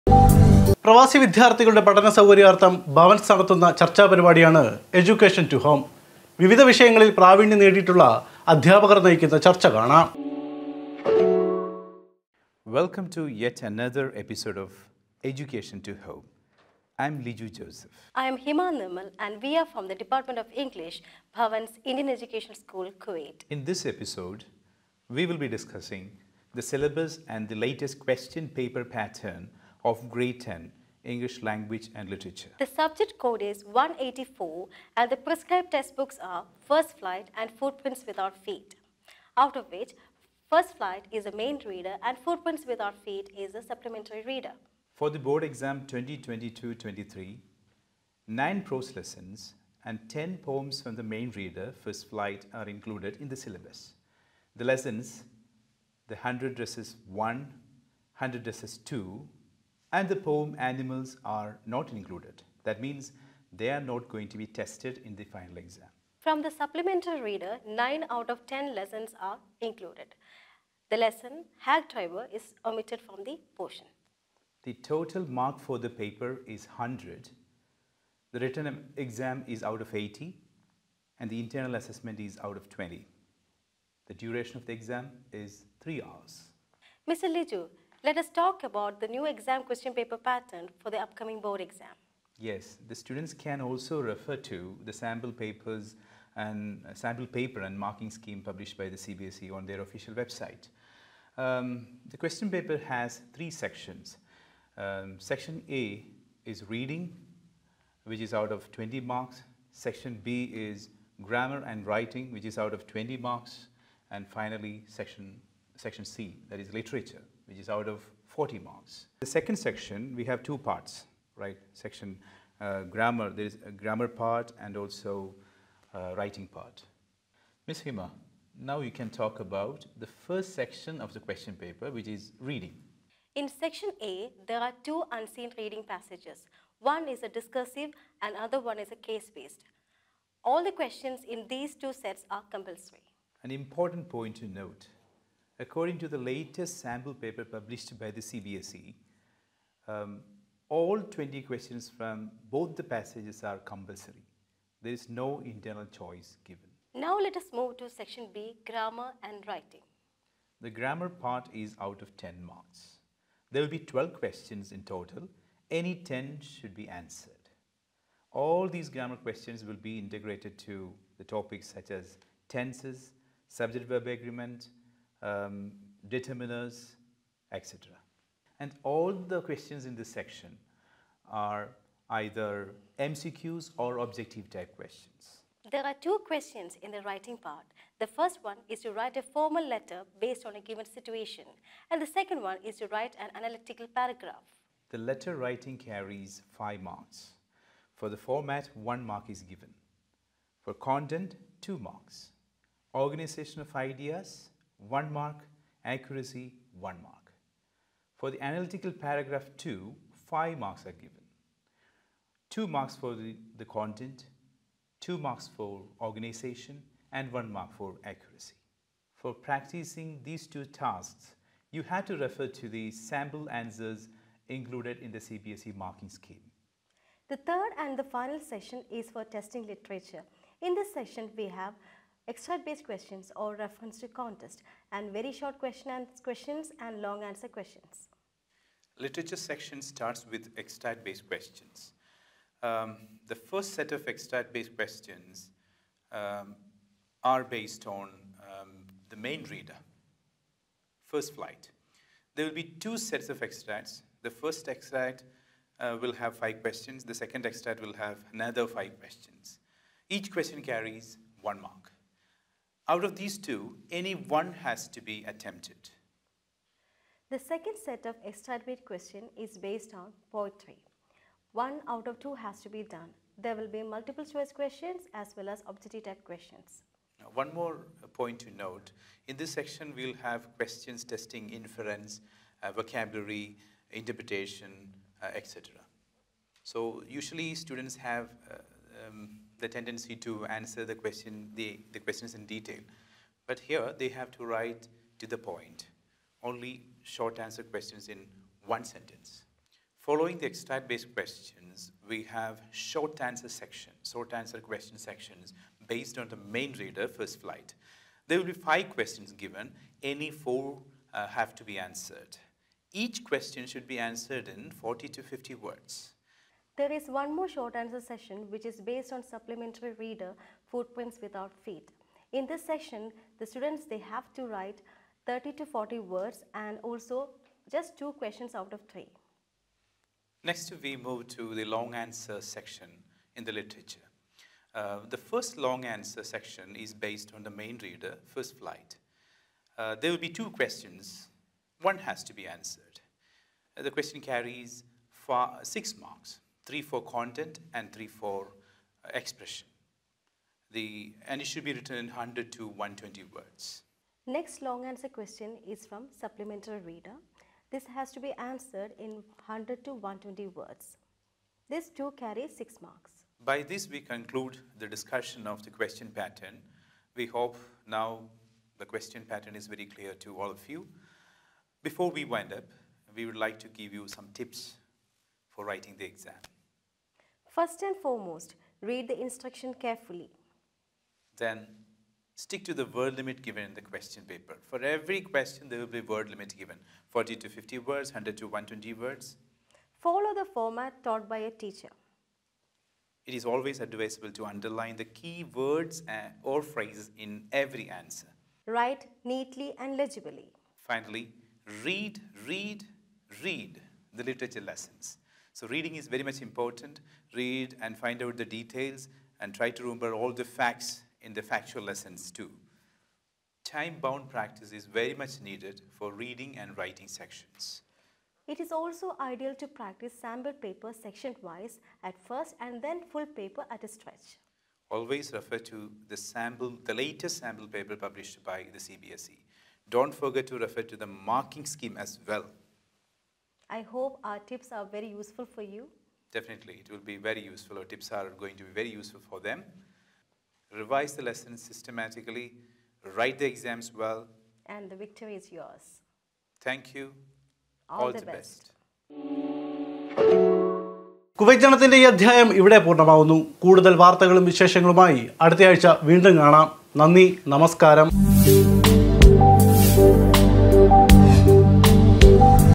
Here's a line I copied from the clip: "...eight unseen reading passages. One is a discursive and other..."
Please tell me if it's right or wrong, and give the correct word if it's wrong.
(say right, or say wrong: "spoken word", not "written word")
wrong: "two", not "eight".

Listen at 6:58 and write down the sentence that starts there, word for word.
It is also ideal to practice sample paper section-wise at first and then full paper at a stretch.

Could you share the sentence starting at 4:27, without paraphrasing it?
The second set of extract-based question is based on poetry.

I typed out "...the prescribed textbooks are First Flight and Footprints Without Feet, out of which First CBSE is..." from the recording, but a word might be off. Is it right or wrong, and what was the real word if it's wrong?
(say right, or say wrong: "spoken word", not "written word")
wrong: "Flight", not "CBSE".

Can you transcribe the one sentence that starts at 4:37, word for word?
Now, one more uh, point to note.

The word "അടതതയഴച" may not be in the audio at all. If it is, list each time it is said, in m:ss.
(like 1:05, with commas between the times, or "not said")
7:35.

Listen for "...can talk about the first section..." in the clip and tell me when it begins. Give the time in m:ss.
2:08.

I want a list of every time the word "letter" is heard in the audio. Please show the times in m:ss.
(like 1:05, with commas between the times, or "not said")
3:09, 3:14.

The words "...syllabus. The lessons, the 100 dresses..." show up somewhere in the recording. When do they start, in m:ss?
0:53.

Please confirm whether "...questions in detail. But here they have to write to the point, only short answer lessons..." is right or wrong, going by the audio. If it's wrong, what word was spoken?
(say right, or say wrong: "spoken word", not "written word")
wrong: "questions", not "lessons".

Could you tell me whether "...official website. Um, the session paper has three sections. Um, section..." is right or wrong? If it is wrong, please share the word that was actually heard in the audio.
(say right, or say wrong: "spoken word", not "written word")
wrong: "question", not "session".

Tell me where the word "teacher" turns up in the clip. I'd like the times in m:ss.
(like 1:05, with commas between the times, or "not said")
6:31.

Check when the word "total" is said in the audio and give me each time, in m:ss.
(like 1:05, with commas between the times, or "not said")
1:14, 2:44.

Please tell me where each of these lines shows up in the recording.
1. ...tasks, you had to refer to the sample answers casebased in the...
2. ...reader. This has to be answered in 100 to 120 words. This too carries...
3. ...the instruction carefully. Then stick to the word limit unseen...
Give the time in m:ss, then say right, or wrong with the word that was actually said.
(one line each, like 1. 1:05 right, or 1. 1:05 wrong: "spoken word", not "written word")
1. 3:40 wrong: "included", not "casebased"
2. 5:56 right
3. 6:19 wrong: "given", not "unseen".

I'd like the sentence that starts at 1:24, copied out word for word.
The duration of the exam is 3 hours.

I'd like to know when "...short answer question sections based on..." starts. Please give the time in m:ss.
5:04.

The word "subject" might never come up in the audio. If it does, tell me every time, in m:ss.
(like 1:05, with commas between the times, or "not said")
0:32, 2:53.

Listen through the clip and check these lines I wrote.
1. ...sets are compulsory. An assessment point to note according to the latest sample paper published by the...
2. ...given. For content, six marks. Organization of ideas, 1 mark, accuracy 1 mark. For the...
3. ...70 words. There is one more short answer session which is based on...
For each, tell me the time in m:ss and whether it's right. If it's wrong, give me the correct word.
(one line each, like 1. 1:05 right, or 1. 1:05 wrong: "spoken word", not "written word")
1. 2:21 wrong: "important", not "assessment"
2. 3:19 wrong: "two", not "six"
3. 5:15 wrong: "50", not "70".